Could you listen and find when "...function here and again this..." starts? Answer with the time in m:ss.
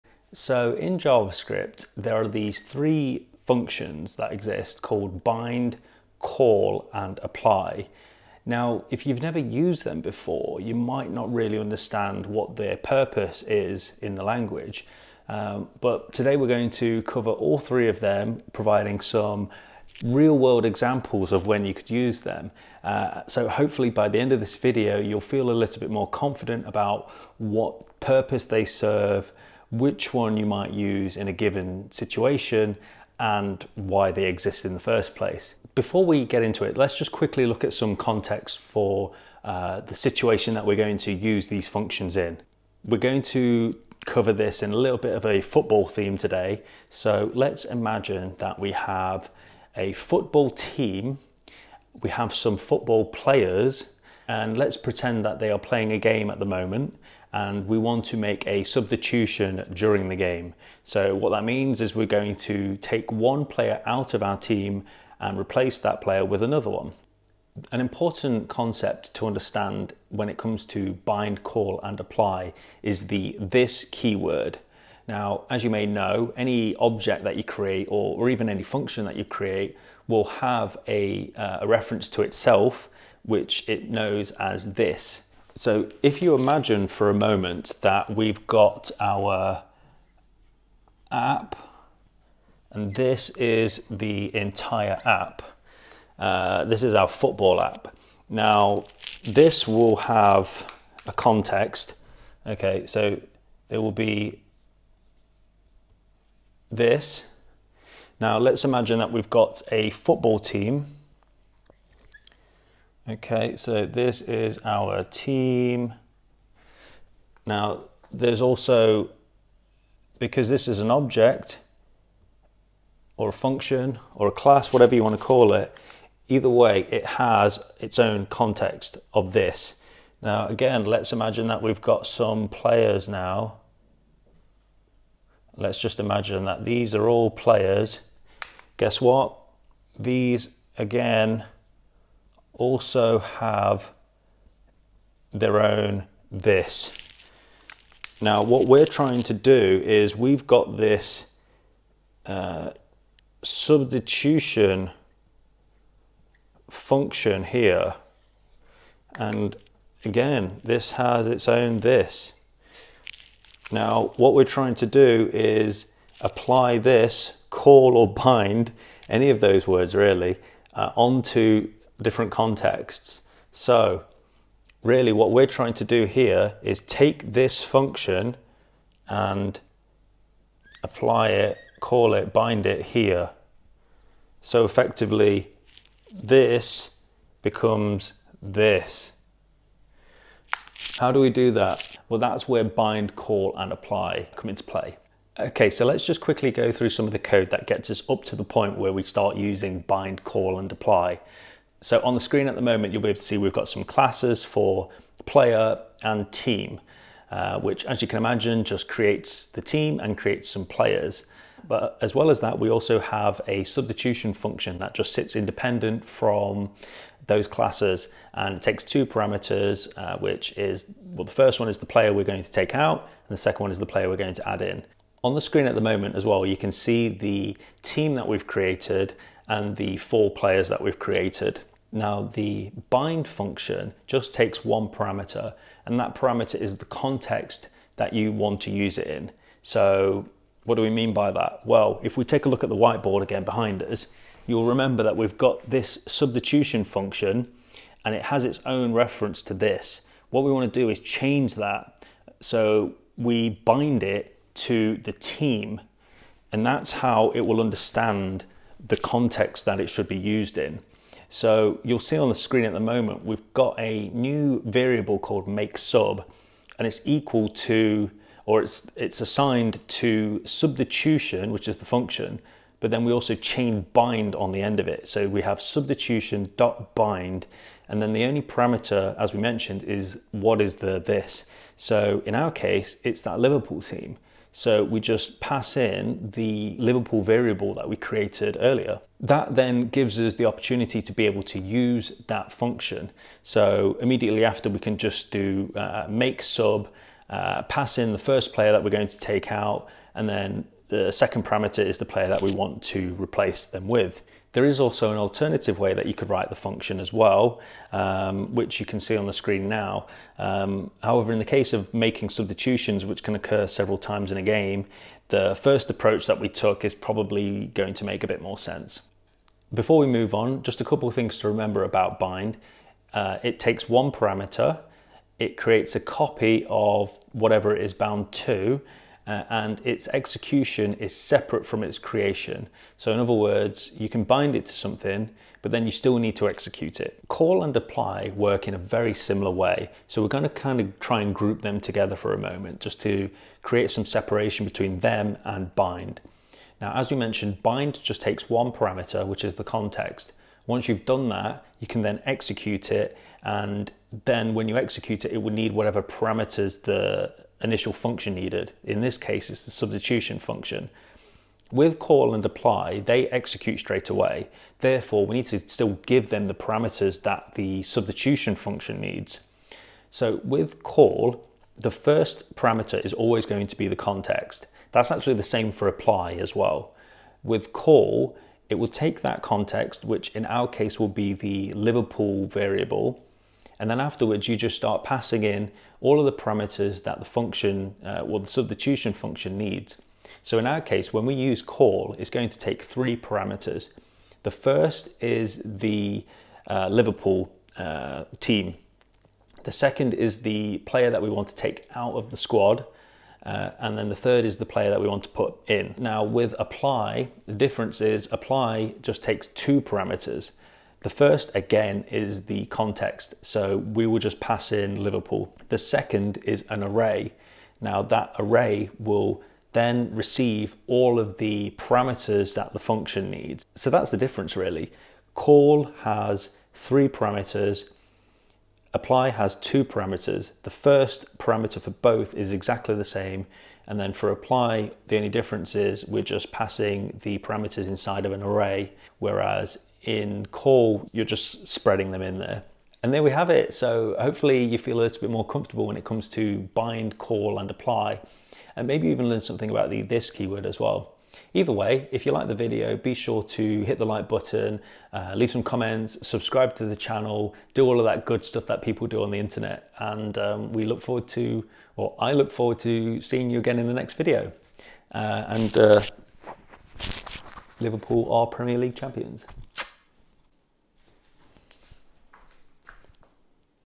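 2:36.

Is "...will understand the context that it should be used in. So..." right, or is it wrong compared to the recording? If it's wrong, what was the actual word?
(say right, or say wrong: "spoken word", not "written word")
right.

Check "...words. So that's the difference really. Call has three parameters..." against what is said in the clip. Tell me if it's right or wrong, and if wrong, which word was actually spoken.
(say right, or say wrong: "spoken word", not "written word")
wrong: "needs", not "words".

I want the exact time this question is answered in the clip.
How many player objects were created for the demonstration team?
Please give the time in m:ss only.
3:49.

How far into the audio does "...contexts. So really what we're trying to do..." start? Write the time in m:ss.
2:52.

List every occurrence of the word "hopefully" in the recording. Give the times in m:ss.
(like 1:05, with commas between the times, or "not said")
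0:23, 7:24.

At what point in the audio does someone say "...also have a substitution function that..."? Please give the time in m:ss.
3:32.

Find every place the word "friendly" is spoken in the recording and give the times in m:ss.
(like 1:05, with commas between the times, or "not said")
not said.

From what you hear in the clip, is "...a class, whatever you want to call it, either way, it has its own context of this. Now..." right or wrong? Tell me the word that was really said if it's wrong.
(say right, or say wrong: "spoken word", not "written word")
right.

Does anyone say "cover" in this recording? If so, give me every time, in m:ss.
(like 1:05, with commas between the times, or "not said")
0:17, 0:44.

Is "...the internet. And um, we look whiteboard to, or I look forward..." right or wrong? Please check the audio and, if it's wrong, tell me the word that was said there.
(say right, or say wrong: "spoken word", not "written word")
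wrong: "forward", not "whiteboard".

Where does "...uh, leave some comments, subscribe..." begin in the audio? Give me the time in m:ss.
7:35.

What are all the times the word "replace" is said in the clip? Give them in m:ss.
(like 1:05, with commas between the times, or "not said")
1:05, 5:03.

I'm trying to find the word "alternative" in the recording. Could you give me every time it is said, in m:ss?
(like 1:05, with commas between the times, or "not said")
5:05.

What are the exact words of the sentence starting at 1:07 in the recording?
An important concept to understand when it comes to bind, call and apply is the this keyword.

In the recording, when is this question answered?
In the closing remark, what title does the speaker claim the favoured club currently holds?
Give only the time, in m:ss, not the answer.
7:48.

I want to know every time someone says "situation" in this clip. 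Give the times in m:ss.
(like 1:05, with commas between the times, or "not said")
0:31, 0:39.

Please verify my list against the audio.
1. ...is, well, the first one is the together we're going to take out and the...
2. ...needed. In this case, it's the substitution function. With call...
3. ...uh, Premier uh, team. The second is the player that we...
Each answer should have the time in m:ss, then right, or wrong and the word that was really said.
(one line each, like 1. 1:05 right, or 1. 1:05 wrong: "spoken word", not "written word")
1. 3:40 wrong: "player", not "together"
2. 5:58 right
3. 6:36 wrong: "Liverpool", not "Premier".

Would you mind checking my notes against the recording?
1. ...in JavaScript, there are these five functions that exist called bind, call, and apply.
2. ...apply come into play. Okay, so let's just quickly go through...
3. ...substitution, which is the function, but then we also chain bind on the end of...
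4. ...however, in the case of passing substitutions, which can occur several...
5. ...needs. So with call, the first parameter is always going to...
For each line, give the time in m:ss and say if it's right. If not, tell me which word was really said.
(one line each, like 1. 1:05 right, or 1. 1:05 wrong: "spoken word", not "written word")
1. 0:00 wrong: "three", not "five"
2. 3:13 right
3. 4:30 right
4. 5:11 wrong: "making", not "passing"
5. 6:08 right.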